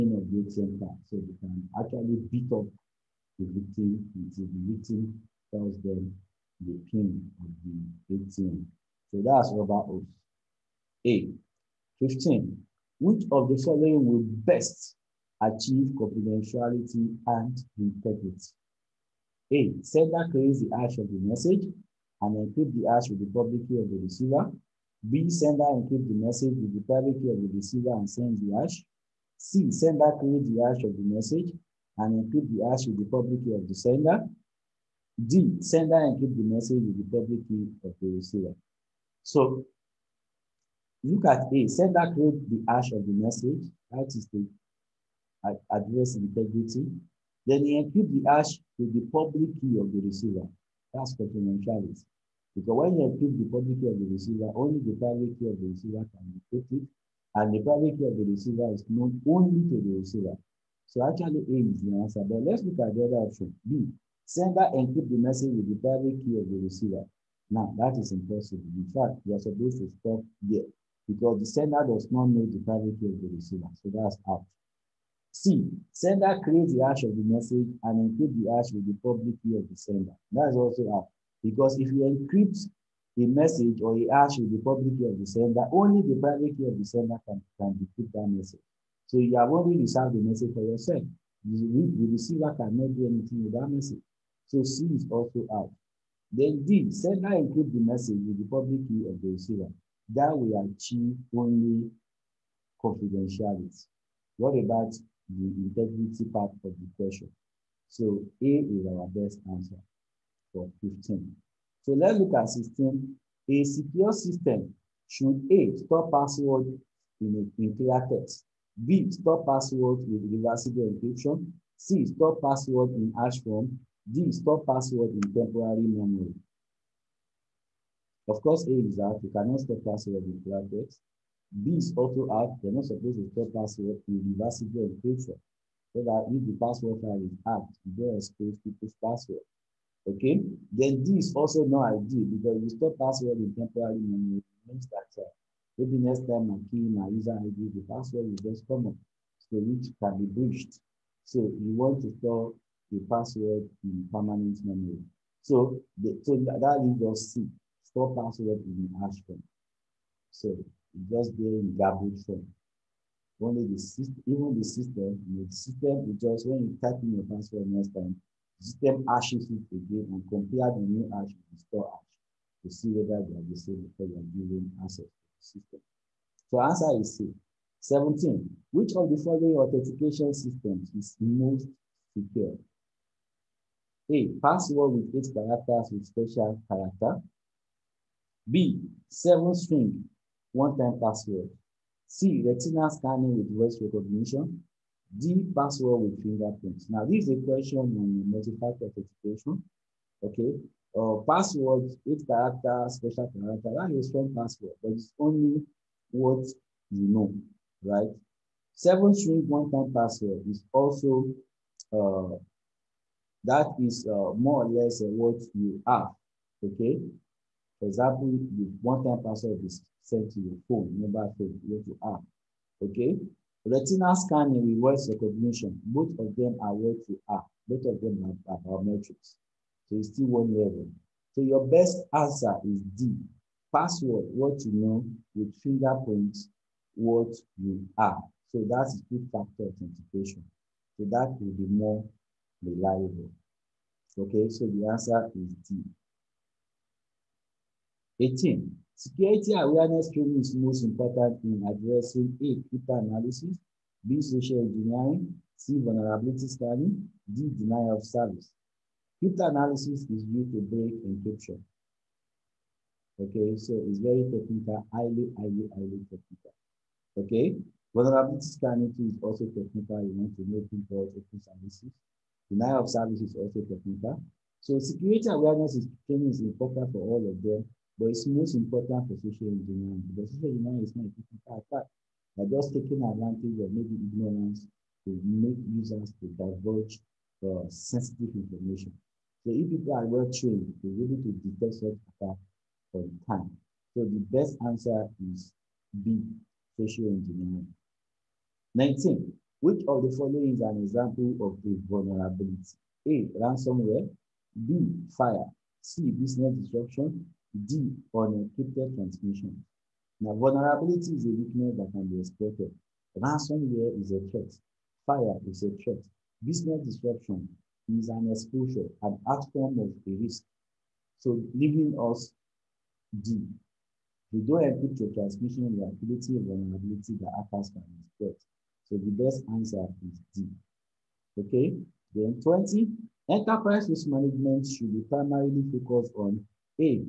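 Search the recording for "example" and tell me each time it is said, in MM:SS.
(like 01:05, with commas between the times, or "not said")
03:37, 05:00.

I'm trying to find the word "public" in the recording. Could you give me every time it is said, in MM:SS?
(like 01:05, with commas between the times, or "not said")
00:23, 00:33, 00:37, 00:49, 00:53, 01:19, 01:24, 01:38.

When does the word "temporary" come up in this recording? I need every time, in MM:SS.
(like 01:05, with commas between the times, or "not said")
02:05, 02:23.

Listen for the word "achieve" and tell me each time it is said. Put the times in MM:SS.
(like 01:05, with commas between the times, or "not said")
00:15, 01:40.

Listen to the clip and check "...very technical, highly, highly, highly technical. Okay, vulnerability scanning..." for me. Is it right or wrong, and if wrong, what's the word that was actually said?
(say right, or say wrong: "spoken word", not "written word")
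right.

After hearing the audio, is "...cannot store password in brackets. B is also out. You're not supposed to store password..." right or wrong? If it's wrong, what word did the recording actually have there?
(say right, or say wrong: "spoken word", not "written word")
right.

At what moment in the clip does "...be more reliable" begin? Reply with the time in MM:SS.
04:01.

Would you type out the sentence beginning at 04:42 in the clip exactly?
They're just taking advantage of maybe ignorance to make users to divulge uh, sensitive information.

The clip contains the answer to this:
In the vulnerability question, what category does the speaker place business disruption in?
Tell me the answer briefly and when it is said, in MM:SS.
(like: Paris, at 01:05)
an exposure, at 05:18.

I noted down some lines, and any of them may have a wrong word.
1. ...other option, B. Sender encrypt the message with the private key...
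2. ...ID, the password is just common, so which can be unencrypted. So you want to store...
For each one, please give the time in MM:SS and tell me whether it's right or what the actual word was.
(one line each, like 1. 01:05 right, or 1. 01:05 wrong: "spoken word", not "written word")
1. 01:03 right
2. 02:27 wrong: "breached", not "unencrypted".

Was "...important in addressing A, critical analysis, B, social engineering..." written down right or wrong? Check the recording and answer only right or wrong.
right.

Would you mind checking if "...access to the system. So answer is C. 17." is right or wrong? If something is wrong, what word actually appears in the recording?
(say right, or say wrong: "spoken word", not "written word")
right.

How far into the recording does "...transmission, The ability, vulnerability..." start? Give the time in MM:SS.
05:25.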